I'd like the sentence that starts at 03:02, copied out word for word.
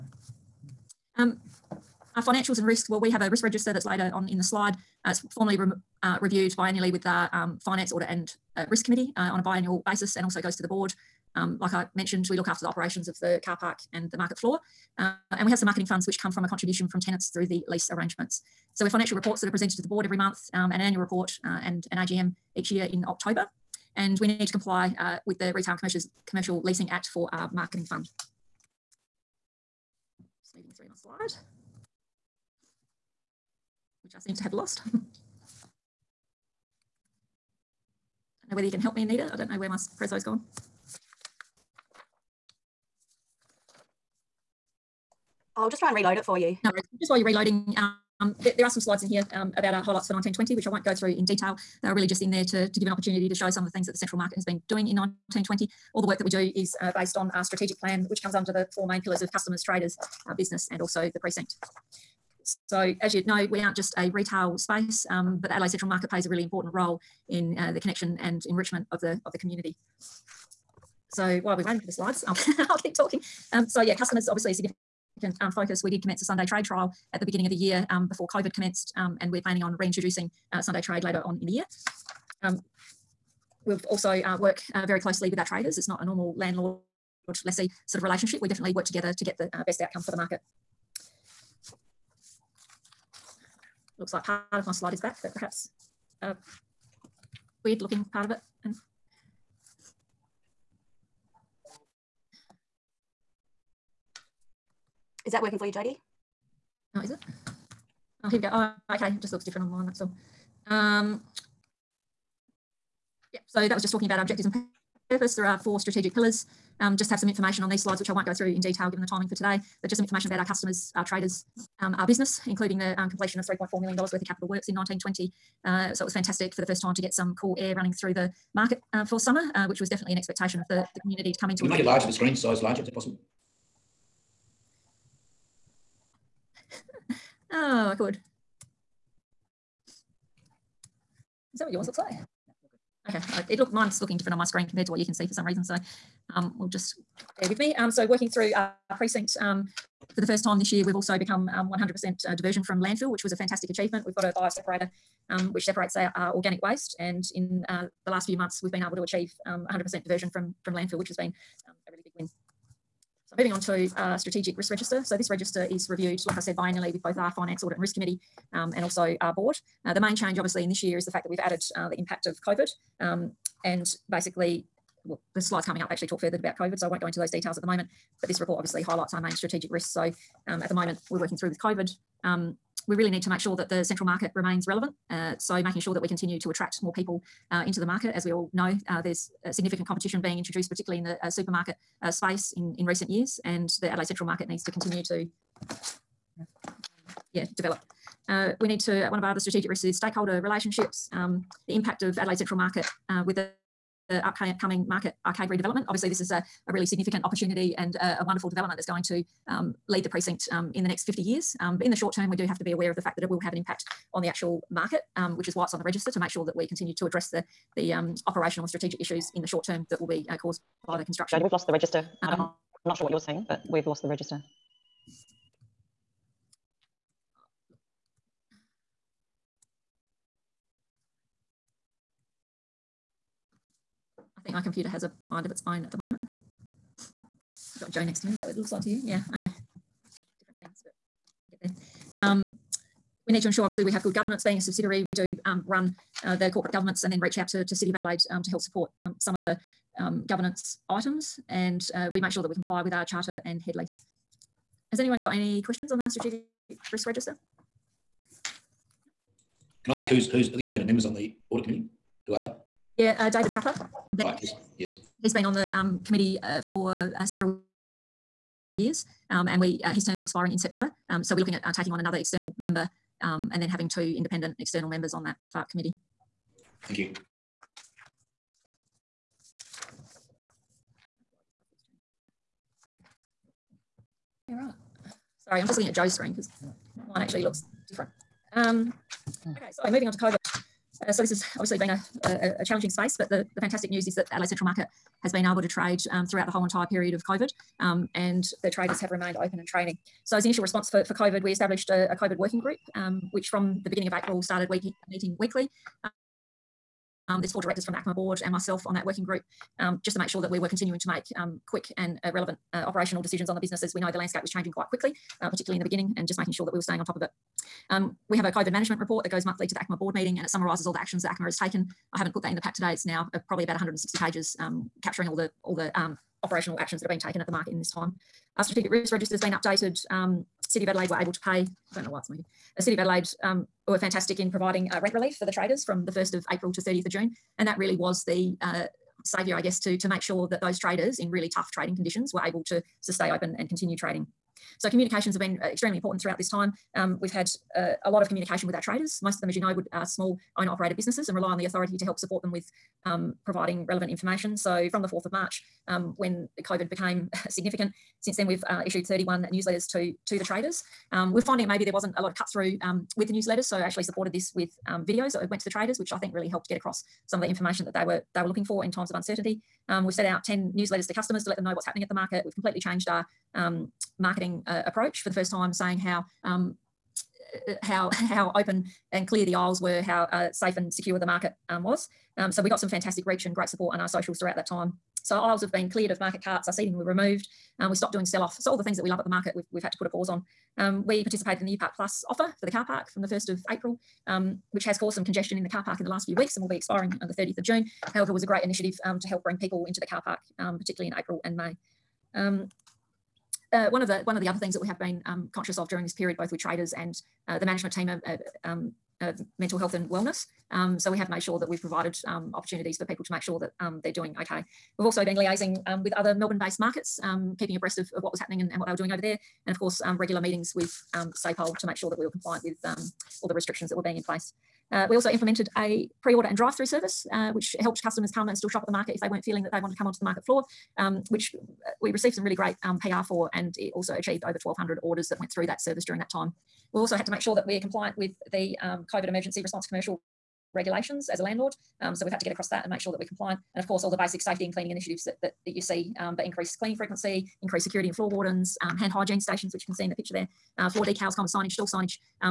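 Um, we really need to make sure that the central market remains relevant.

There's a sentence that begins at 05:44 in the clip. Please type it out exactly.
So communications have been uh, extremely important throughout this time.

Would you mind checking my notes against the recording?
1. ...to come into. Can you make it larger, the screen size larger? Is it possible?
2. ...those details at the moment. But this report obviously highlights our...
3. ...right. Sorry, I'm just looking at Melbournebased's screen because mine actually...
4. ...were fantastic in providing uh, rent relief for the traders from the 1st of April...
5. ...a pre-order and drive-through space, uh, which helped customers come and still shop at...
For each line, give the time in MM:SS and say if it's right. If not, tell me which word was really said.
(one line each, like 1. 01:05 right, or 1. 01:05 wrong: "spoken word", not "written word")
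1. 02:11 right
2. 02:57 right
3. 04:44 wrong: "Joe", not "Melbournebased"
4. 05:33 right
5. 07:05 wrong: "service", not "space".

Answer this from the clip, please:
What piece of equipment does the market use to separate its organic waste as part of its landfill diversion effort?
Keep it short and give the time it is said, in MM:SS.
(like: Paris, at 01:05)
bio separator, at 02:34.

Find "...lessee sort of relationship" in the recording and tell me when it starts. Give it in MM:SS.
01:27.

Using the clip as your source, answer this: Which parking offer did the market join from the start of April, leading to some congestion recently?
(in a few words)
U Park Plus.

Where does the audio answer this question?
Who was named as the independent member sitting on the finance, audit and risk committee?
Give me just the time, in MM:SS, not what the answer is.
04:23.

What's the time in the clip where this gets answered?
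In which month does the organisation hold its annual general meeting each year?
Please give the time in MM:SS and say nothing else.
00:23.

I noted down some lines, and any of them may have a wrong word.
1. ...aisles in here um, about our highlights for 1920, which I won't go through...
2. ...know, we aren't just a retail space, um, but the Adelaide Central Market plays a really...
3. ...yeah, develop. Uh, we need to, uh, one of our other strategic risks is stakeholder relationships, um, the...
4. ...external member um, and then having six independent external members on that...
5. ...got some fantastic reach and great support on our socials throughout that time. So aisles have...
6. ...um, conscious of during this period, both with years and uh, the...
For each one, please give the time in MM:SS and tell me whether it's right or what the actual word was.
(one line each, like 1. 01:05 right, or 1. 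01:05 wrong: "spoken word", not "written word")
1. 00:48 wrong: "slides", not "aisles"
2. 01:03 right
3. 03:17 right
4. 04:32 wrong: "two", not "six"
5. 06:22 right
6. 06:45 wrong: "traders", not "years".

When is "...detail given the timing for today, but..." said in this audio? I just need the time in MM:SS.
01:58.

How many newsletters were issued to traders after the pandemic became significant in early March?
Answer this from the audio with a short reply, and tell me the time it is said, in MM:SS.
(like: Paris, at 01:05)
31, at 05:59.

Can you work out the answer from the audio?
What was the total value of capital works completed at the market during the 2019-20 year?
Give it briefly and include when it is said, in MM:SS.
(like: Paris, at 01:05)
$3.4 million, at 02:03.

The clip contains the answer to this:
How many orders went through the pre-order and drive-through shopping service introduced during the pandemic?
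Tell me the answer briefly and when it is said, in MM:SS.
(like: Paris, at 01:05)
1,200, at 07:14.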